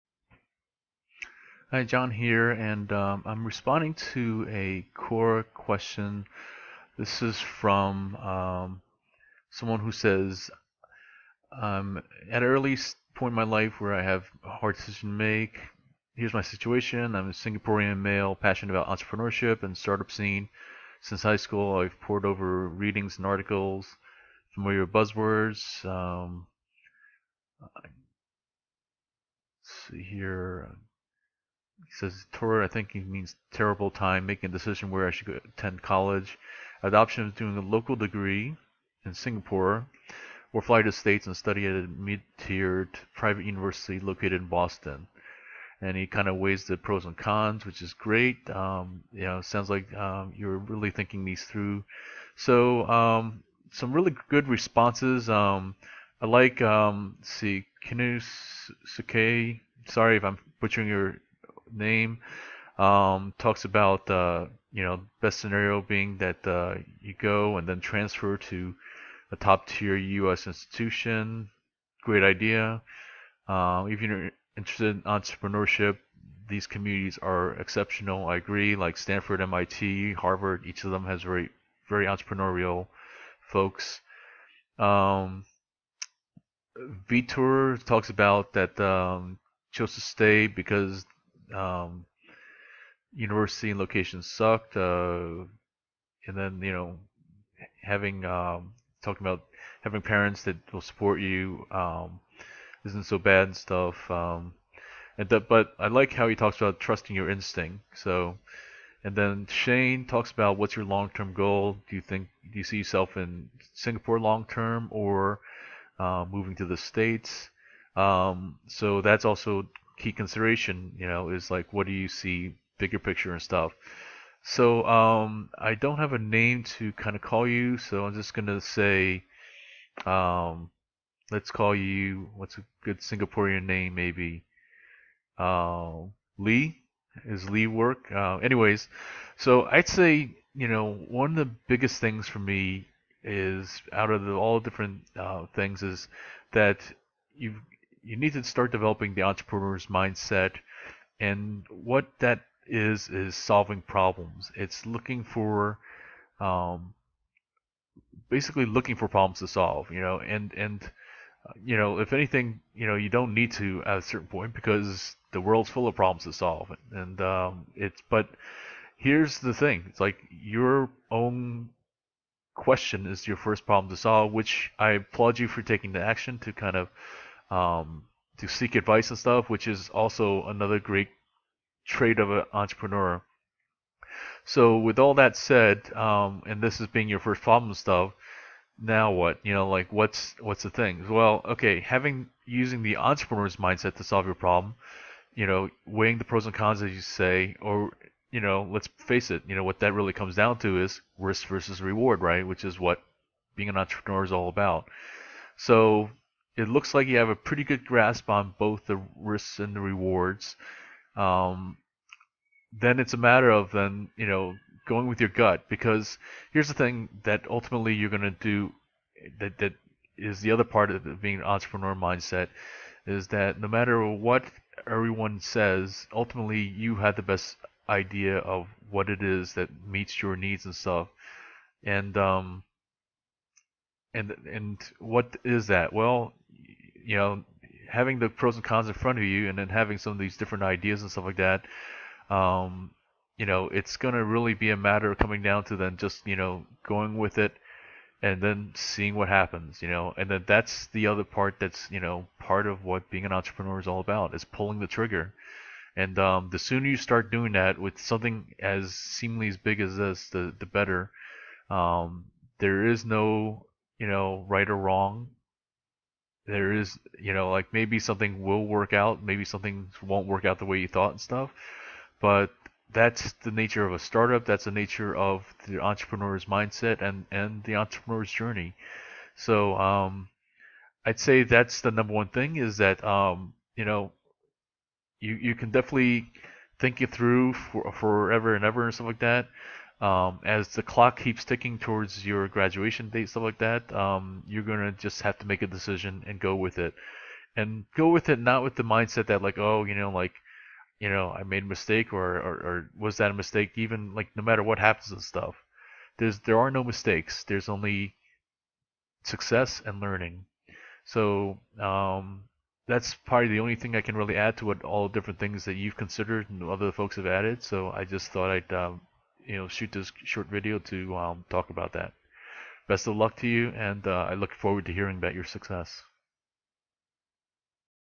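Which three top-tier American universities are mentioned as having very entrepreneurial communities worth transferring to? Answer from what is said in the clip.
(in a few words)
Stanford, MIT, Harvard.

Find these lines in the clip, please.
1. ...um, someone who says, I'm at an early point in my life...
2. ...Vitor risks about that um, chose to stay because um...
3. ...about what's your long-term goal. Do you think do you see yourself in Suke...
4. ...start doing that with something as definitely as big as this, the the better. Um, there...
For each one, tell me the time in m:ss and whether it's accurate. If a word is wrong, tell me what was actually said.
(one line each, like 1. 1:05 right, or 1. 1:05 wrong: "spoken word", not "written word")
1. 0:08 right
2. 1:27 wrong: "talks", not "risks"
3. 1:50 wrong: "Singapore", not "Suke"
4. 4:16 wrong: "seemingly", not "definitely".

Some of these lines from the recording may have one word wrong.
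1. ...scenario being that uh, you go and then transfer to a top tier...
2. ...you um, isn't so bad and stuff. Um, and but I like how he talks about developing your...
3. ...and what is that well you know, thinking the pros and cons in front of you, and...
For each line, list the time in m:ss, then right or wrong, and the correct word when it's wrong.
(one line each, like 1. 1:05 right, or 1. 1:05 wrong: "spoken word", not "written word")
1. 1:05 right
2. 1:41 wrong: "trusting", not "developing"
3. 3:54 wrong: "having", not "thinking".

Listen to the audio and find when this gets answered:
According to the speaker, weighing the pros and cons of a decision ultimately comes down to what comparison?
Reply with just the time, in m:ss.
3:21.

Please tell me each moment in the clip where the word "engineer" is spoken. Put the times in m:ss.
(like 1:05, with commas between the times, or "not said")
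not said.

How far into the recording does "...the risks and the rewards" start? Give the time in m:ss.
3:28.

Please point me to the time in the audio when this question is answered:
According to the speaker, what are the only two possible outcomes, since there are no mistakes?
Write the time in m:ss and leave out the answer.
5:09.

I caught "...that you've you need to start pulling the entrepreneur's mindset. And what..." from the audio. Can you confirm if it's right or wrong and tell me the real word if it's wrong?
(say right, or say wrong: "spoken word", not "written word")
wrong: "developing", not "pulling".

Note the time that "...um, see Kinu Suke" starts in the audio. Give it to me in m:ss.
0:56.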